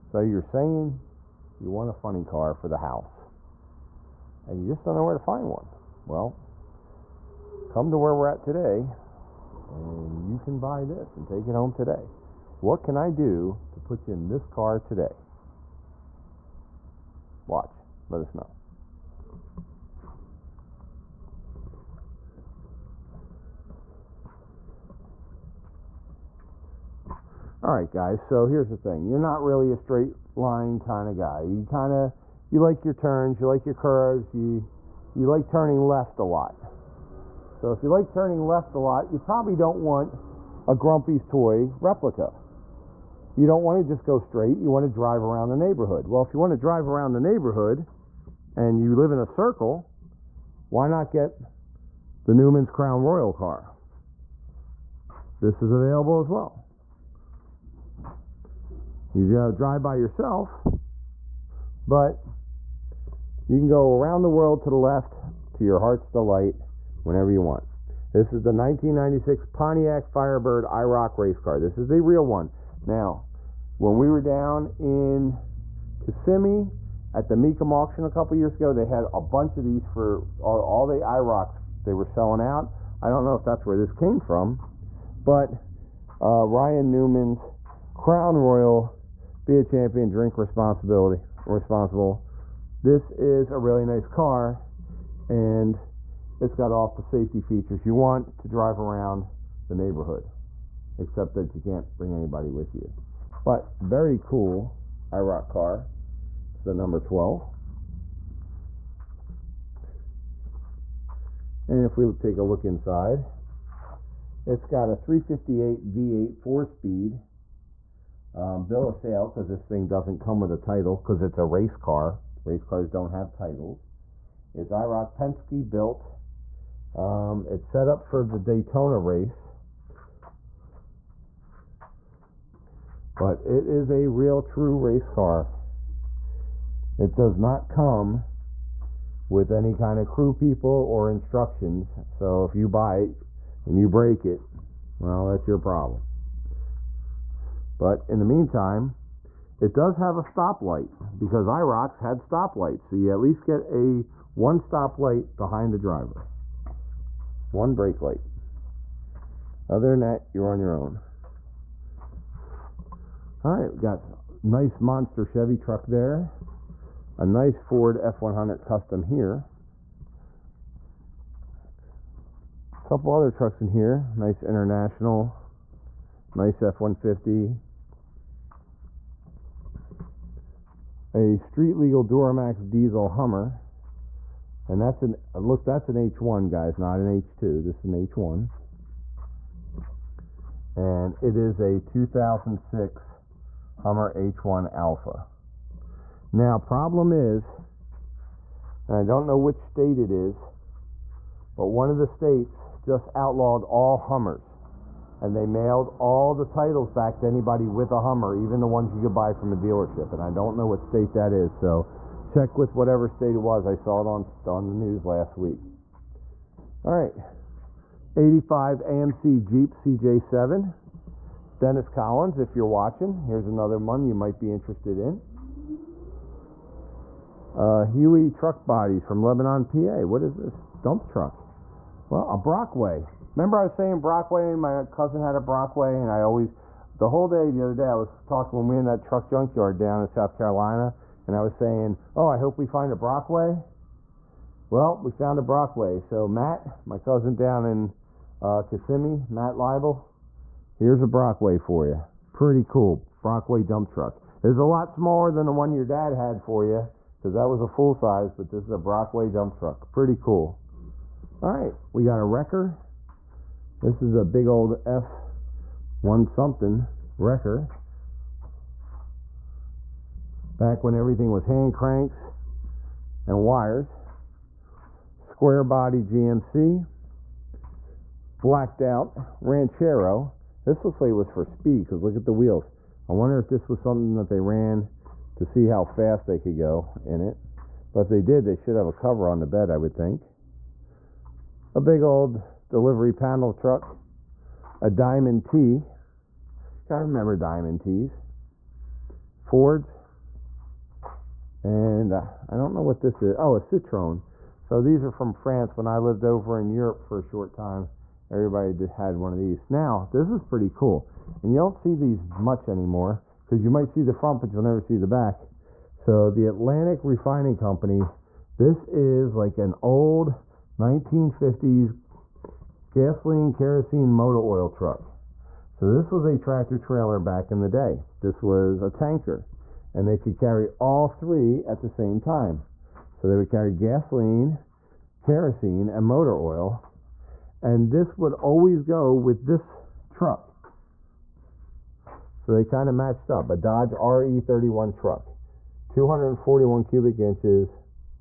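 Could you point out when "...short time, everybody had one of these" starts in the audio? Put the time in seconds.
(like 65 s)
307 s.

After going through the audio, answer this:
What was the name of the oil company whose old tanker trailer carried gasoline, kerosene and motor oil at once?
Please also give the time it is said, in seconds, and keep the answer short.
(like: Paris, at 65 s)
Atlantic Refining Company, at 316 s.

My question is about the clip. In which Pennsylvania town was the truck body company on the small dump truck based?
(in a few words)
Lebanon.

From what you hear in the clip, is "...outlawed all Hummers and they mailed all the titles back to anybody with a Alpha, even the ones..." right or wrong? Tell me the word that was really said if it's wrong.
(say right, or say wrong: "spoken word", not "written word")
wrong: "Hummer", not "Alpha".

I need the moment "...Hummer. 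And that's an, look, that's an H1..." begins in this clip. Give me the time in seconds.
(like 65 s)
183 s.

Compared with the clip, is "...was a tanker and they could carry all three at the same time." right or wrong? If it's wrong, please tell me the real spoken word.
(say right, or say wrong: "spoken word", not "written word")
right.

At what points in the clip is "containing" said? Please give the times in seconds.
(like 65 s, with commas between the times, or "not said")
not said.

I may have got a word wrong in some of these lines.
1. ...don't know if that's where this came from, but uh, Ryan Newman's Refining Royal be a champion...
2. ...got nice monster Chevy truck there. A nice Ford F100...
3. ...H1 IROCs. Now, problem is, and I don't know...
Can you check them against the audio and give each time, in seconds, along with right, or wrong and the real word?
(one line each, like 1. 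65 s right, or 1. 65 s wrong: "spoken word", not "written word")
1. 83 s wrong: "Crown", not "Refining"
2. 163 s right
3. 194 s wrong: "Alpha", not "IROCs".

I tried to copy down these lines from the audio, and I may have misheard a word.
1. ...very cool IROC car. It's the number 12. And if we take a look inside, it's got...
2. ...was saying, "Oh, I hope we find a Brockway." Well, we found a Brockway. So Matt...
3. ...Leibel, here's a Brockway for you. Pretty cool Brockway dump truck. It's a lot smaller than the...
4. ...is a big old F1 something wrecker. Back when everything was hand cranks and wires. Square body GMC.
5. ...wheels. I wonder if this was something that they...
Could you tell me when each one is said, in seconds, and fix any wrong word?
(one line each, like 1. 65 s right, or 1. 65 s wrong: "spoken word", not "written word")
1. 103 s right
2. 241 s right
3. 249 s right
4. 264 s right
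5. 282 s right.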